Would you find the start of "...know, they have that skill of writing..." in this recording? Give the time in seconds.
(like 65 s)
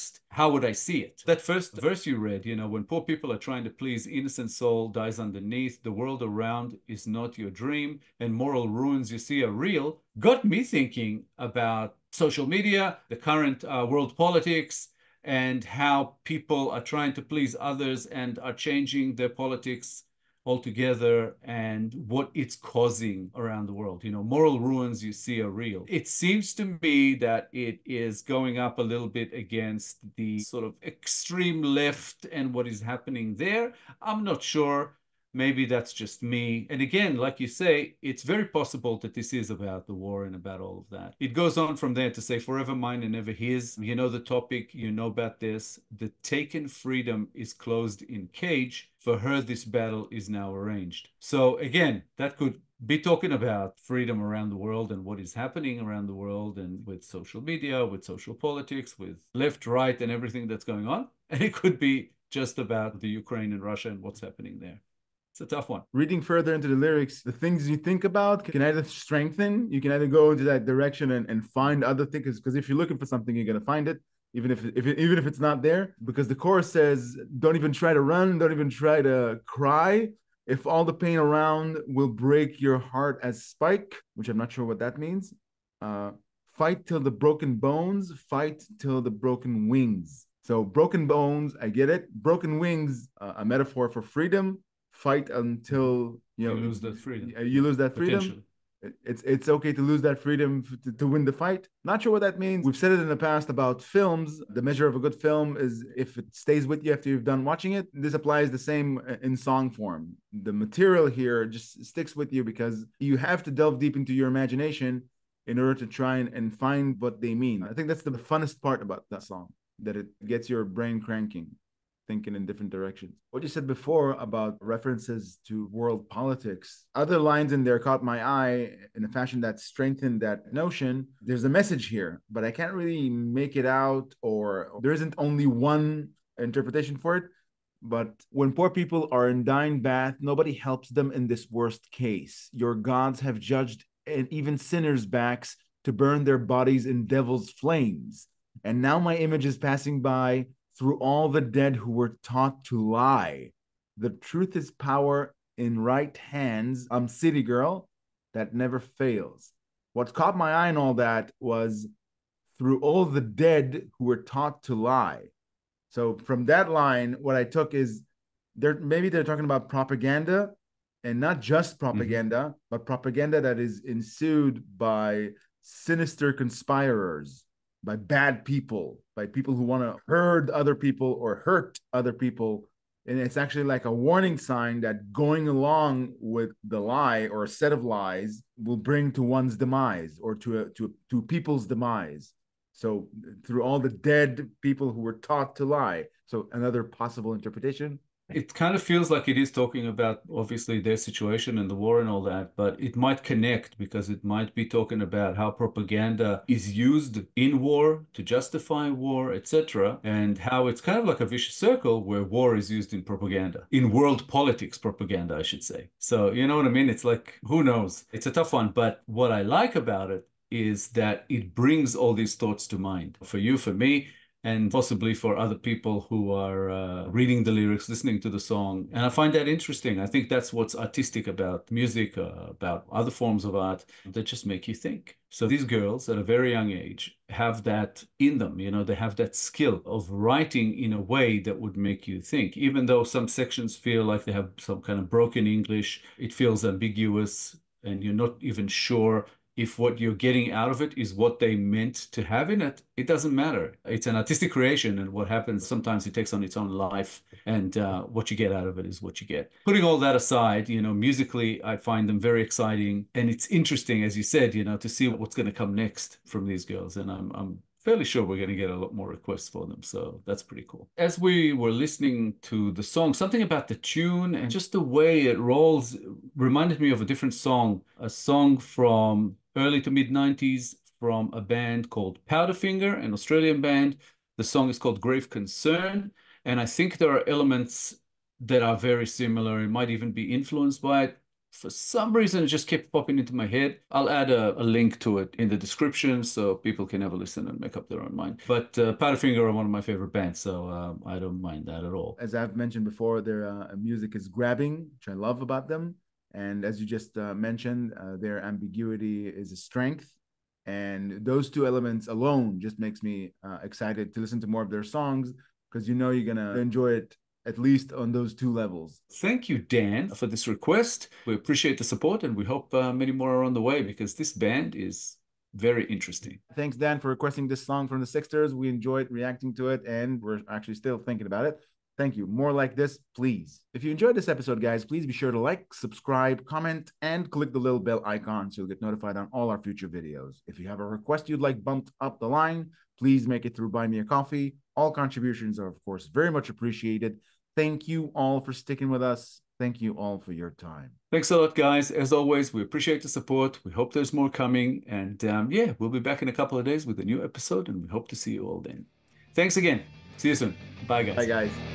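238 s.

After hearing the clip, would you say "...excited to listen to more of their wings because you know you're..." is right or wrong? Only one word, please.
wrong.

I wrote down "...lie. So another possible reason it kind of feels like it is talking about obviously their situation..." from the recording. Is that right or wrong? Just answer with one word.
wrong.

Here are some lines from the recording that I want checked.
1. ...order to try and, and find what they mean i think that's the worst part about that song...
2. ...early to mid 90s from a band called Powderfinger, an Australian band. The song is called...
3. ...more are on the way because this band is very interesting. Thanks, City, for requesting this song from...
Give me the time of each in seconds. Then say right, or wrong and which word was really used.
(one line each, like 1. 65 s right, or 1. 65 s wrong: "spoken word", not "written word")
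1. 115 s wrong: "funnest", not "worst"
2. 279 s right
3. 323 s wrong: "Dan", not "City".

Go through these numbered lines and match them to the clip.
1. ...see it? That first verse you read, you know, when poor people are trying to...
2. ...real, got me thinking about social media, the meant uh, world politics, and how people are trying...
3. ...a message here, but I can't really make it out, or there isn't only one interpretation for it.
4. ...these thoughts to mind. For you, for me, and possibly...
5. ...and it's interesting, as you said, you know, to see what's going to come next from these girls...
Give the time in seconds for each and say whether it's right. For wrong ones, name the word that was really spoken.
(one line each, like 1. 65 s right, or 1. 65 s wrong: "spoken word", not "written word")
1. 0 s right
2. 9 s wrong: "current", not "meant"
3. 131 s right
4. 222 s right
5. 263 s right.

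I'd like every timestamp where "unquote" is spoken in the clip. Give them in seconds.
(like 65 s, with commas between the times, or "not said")
not said.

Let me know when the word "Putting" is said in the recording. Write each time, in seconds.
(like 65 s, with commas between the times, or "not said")
259 s.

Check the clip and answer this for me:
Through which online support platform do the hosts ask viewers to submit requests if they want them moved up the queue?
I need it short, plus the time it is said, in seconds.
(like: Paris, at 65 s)
Buy Me a Coffee, at 343 s.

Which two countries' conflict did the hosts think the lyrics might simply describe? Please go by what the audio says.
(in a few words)
Ukraine and Russia.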